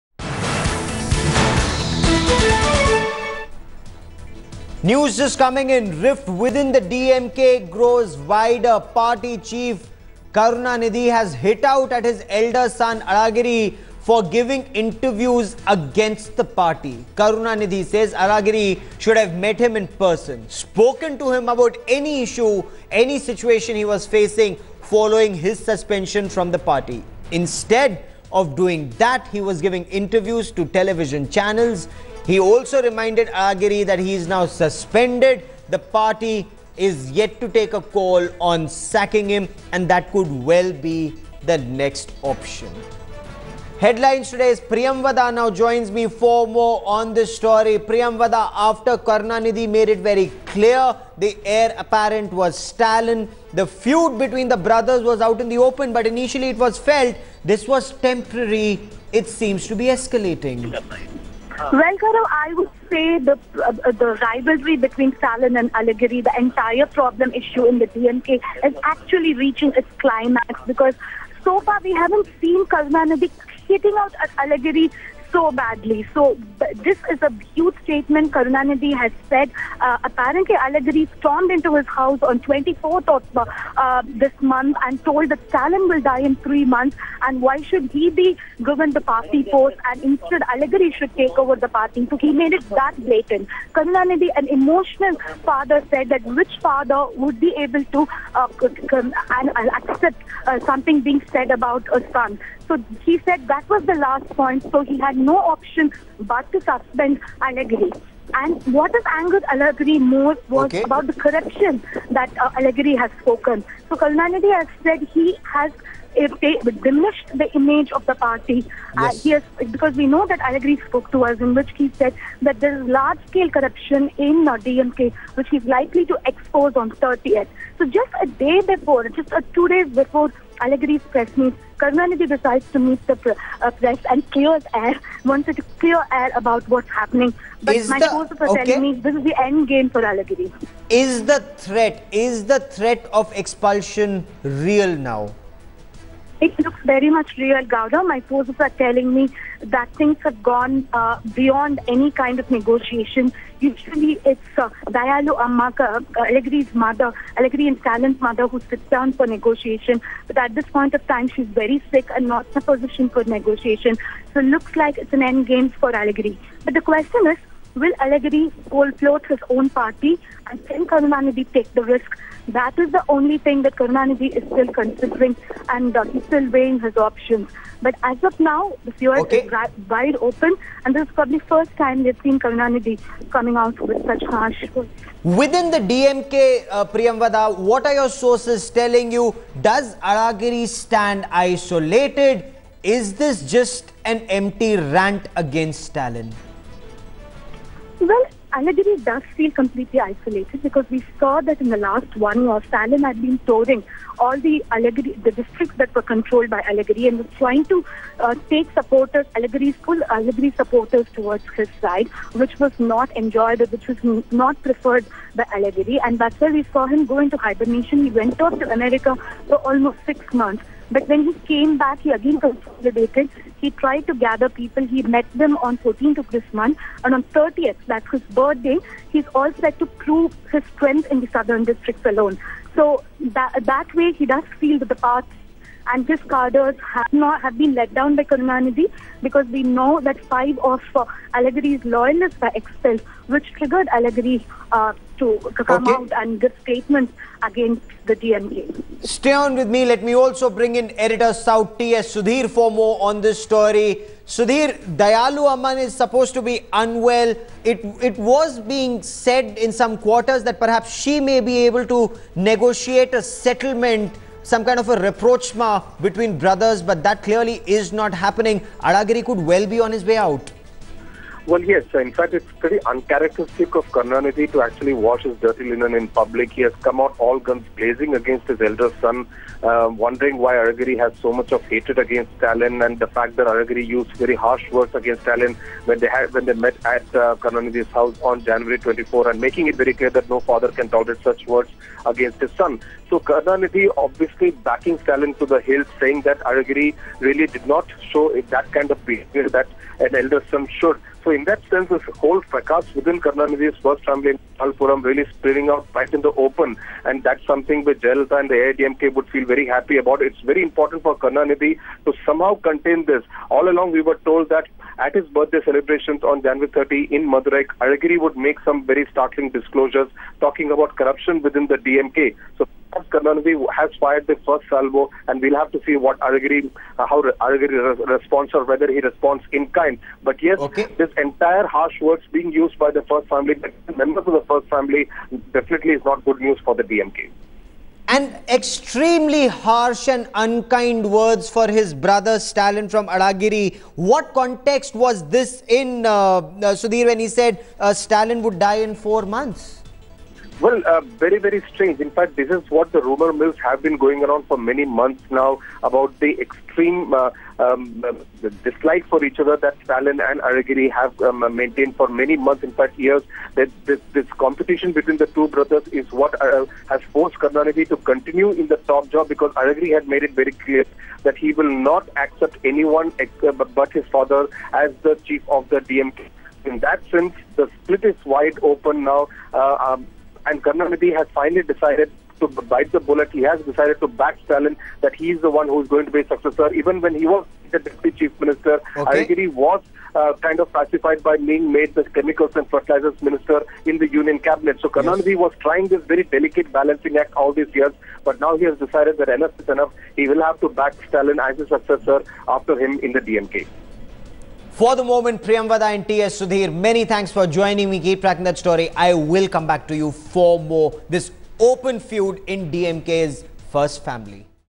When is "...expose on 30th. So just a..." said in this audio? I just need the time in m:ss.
2:06.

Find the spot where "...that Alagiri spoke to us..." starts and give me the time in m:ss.
2:00.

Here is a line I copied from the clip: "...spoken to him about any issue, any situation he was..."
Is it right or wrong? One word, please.
right.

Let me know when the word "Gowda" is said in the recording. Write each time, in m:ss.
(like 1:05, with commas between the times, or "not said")
2:27.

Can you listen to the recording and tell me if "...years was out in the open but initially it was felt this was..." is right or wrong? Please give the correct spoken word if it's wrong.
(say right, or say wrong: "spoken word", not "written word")
wrong: "brothers", not "years".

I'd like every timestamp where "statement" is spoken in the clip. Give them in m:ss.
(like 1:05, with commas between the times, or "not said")
1:17, 4:06.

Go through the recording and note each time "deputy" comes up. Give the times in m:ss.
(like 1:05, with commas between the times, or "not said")
6:27.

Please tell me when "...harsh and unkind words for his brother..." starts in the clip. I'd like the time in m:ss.
5:39.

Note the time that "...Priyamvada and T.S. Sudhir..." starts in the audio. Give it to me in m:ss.
6:45.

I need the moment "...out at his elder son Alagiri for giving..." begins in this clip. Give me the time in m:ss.
0:11.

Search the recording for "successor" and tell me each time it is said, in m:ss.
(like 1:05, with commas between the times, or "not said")
6:26, 6:41.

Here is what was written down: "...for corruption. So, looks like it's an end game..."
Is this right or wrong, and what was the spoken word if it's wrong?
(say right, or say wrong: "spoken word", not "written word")
wrong: "negotiation", not "corruption".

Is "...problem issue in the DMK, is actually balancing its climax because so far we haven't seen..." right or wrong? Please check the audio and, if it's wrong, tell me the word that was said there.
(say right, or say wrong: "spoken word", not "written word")
wrong: "reaching", not "balancing".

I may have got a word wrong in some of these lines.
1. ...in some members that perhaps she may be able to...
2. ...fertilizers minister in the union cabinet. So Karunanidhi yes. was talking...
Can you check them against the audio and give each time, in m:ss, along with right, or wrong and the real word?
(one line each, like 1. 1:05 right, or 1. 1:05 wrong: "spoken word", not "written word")
1. 4:19 wrong: "quarters", not "members"
2. 6:32 wrong: "trying", not "talking".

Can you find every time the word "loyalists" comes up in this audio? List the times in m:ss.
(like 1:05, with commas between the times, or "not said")
4:01.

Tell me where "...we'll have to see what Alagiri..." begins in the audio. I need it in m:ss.
5:25.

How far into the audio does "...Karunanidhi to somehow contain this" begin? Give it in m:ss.
5:11.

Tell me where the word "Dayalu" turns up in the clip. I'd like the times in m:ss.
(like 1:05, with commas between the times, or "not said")
2:34, 4:14.